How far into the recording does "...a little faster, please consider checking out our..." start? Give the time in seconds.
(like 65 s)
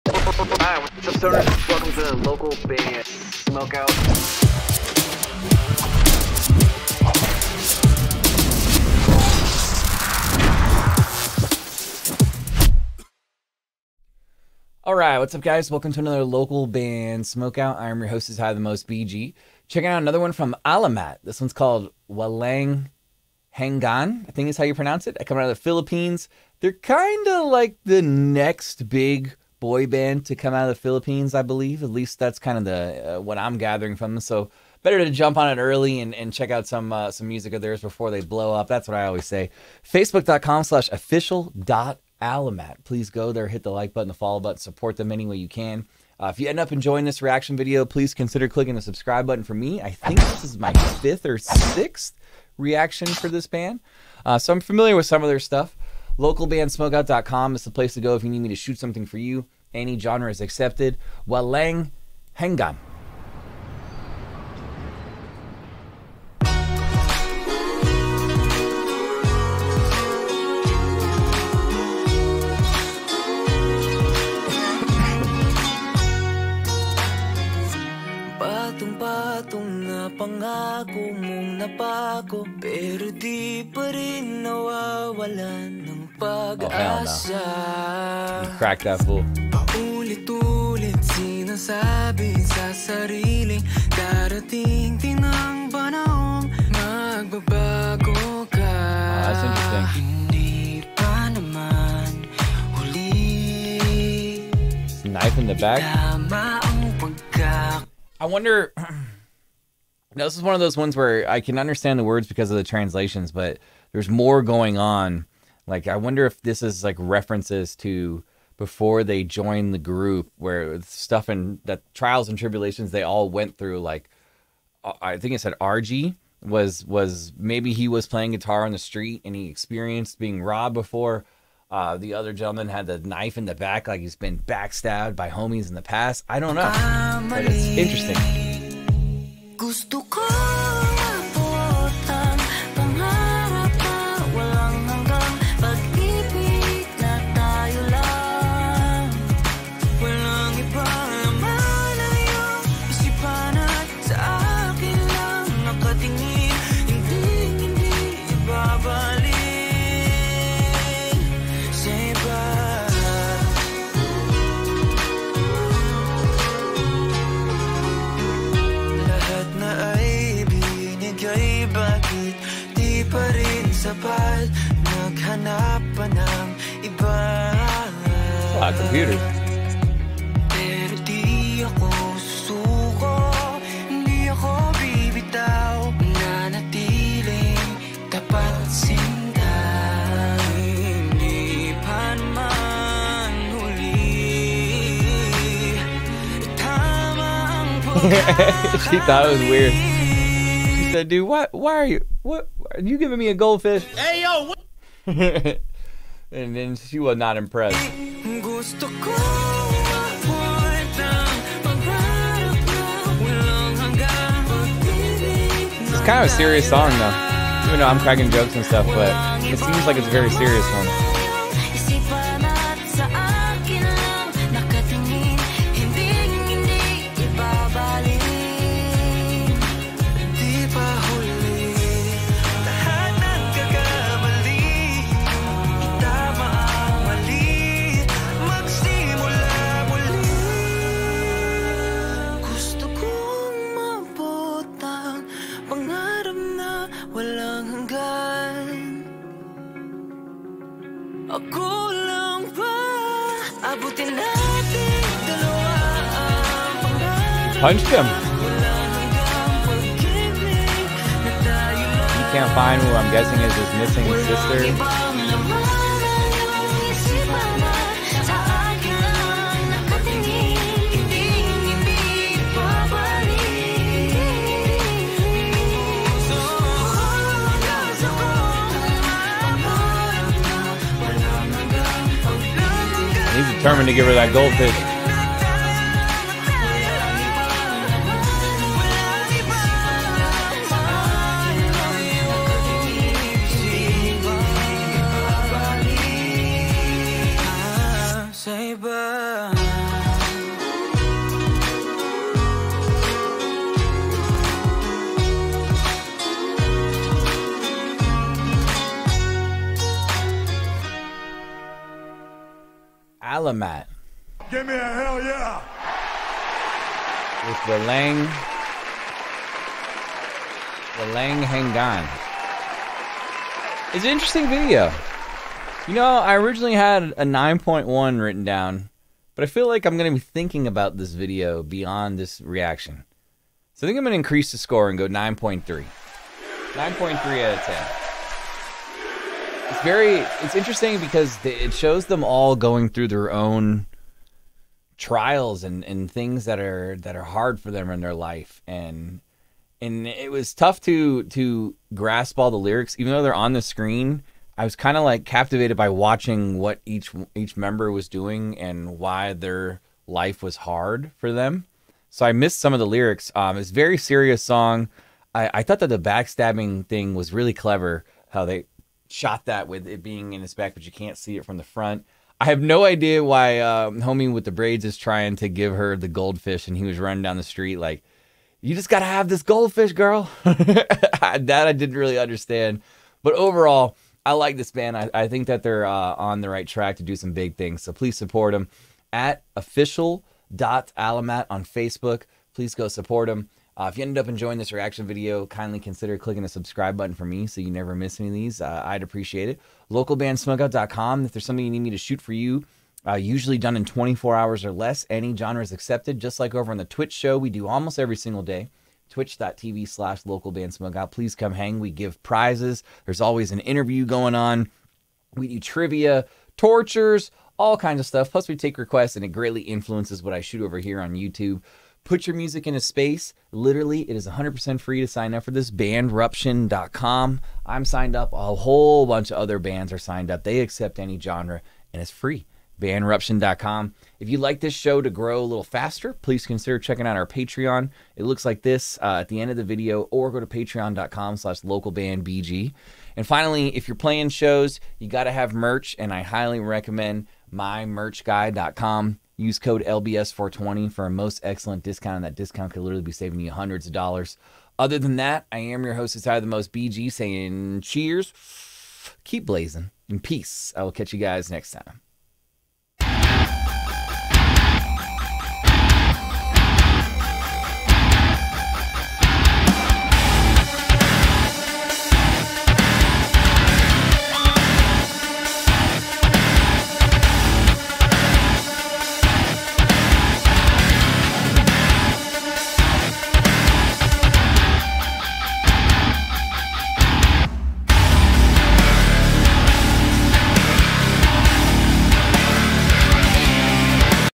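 435 s.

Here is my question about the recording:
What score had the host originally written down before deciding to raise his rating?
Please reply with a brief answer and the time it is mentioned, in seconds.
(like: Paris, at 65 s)
9.1, at 327 s.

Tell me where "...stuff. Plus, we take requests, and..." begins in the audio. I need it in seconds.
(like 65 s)
418 s.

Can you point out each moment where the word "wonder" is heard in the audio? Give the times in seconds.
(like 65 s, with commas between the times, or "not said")
108 s, 115 s.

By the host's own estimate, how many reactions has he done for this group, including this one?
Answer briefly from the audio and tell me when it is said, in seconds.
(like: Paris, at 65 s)
fifth or sixth, at 51 s.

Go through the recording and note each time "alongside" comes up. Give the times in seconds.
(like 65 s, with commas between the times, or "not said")
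not said.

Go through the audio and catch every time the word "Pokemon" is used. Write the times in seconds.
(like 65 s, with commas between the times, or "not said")
not said.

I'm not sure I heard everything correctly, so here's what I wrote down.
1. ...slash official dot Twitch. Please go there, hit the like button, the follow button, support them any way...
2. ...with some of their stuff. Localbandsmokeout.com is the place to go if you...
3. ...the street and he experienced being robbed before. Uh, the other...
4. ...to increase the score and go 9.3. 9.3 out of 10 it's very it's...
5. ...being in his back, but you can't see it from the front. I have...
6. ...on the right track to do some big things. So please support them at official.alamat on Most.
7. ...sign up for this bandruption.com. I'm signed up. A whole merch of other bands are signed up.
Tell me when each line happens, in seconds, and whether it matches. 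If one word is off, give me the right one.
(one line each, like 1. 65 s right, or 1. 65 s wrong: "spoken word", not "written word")
1. 40 s wrong: "Alamat", not "Twitch"
2. 54 s right
3. 128 s right
4. 334 s right
5. 370 s right
6. 386 s wrong: "Facebook", not "Most"
7. 425 s wrong: "bunch", not "merch".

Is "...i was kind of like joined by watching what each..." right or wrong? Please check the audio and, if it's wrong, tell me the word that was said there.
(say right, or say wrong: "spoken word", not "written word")
wrong: "captivated", not "joined".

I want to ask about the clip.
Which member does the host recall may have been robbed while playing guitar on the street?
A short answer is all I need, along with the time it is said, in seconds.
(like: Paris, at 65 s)
RG, at 125 s.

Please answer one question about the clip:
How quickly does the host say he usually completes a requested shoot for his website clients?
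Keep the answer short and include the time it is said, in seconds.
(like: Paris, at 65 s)
24 hours or less, at 403 s.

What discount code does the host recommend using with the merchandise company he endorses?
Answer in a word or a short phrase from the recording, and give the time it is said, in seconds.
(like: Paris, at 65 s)
LBS420, at 449 s.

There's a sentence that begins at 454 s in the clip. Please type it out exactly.
Other than that, I am your host, Inside the Most BG, saying cheers, keep blazing, and peace.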